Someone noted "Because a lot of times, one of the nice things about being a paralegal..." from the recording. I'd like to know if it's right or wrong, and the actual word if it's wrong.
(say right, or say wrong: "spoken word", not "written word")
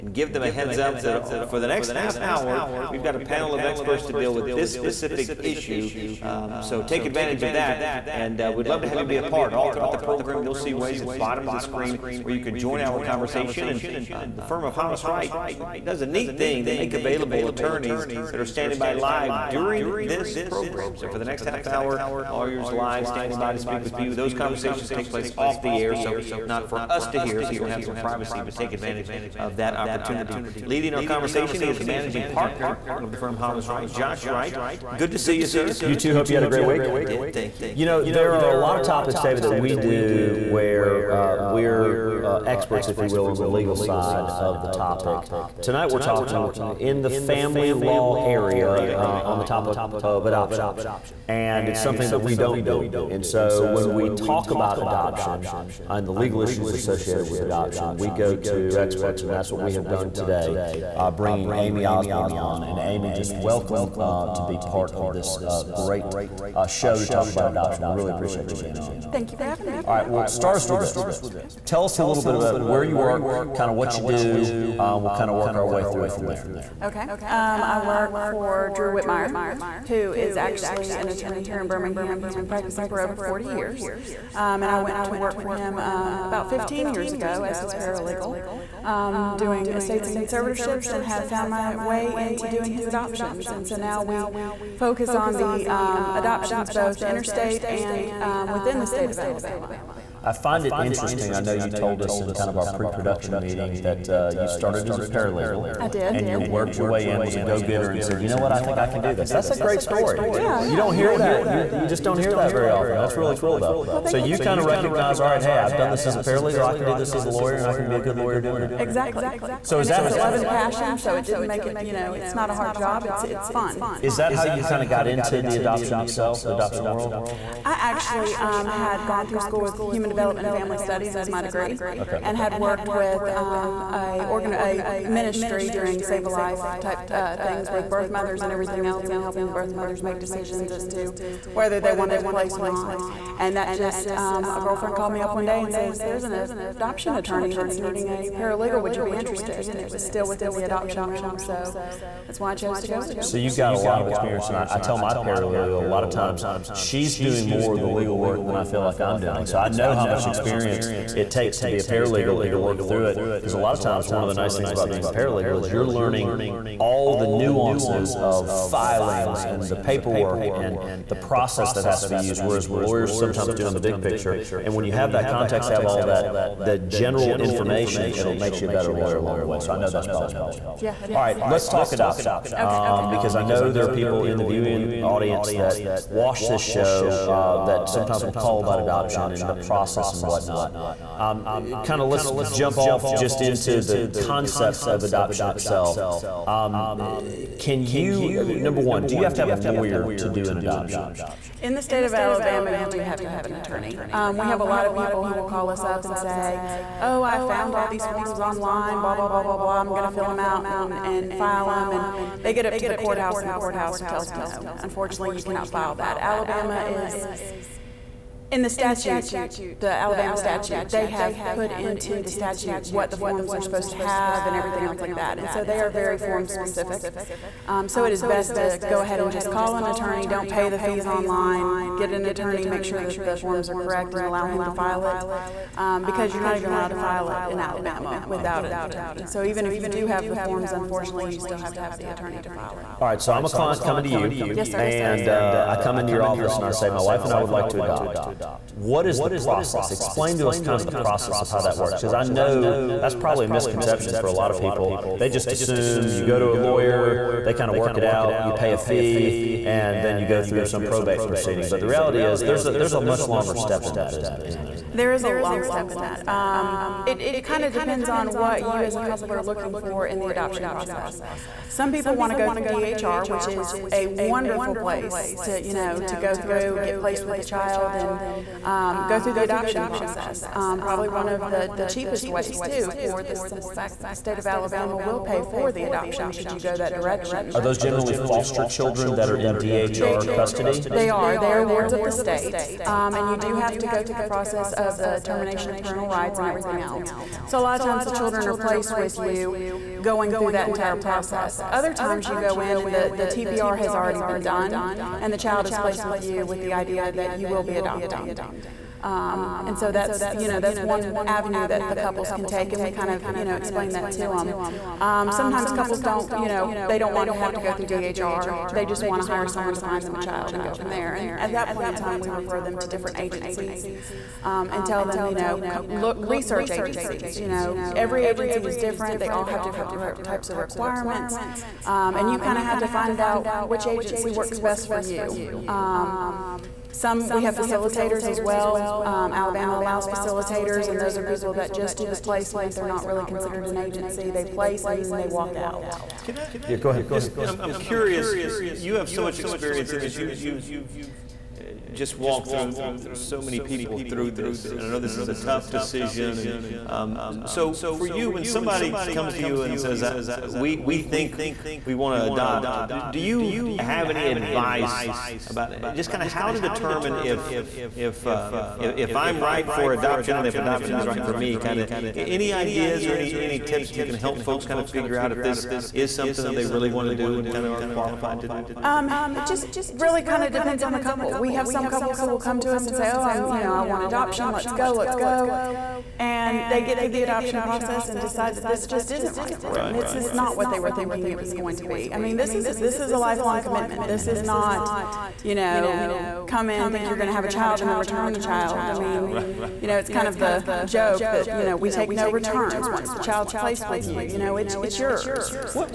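right.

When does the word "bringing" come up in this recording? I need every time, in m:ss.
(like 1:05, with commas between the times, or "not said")
1:01.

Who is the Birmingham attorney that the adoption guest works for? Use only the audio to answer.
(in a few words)
Drew Whitmire.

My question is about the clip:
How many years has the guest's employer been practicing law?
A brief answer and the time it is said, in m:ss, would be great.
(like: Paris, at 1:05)
40, at 1:22.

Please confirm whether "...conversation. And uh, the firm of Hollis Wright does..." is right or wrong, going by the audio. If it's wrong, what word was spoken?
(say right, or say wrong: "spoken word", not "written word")
right.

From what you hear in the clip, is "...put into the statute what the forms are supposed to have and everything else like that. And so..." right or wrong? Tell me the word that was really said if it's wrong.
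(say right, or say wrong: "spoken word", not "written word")
right.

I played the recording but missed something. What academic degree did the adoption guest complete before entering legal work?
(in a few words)
human development and family studies.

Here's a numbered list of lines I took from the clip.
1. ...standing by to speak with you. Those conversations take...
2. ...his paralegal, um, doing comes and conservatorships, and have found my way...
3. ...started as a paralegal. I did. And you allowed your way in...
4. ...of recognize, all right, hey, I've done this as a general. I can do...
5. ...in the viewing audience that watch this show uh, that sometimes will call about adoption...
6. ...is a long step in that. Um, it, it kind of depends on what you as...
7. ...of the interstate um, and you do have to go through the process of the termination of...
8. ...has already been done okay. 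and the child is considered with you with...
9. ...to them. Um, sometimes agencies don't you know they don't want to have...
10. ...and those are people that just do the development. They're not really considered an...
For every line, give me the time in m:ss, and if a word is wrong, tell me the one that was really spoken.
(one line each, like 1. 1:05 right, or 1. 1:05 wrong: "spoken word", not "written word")
1. 0:23 right
2. 1:27 wrong: "estates", not "comes"
3. 1:44 wrong: "worked", not "allowed"
4. 1:54 wrong: "paralegal", not "general"
5. 3:04 right
6. 4:25 right
7. 4:51 wrong: "state", not "interstate"
8. 5:03 wrong: "placed", not "considered"
9. 5:14 wrong: "couples", not "agencies"
10. 5:40 wrong: "placement", not "development".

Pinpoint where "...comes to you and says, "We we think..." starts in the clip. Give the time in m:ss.
5:59.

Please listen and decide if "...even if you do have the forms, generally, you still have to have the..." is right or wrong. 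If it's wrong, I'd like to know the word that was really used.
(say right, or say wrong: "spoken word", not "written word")
wrong: "unfortunately", not "generally".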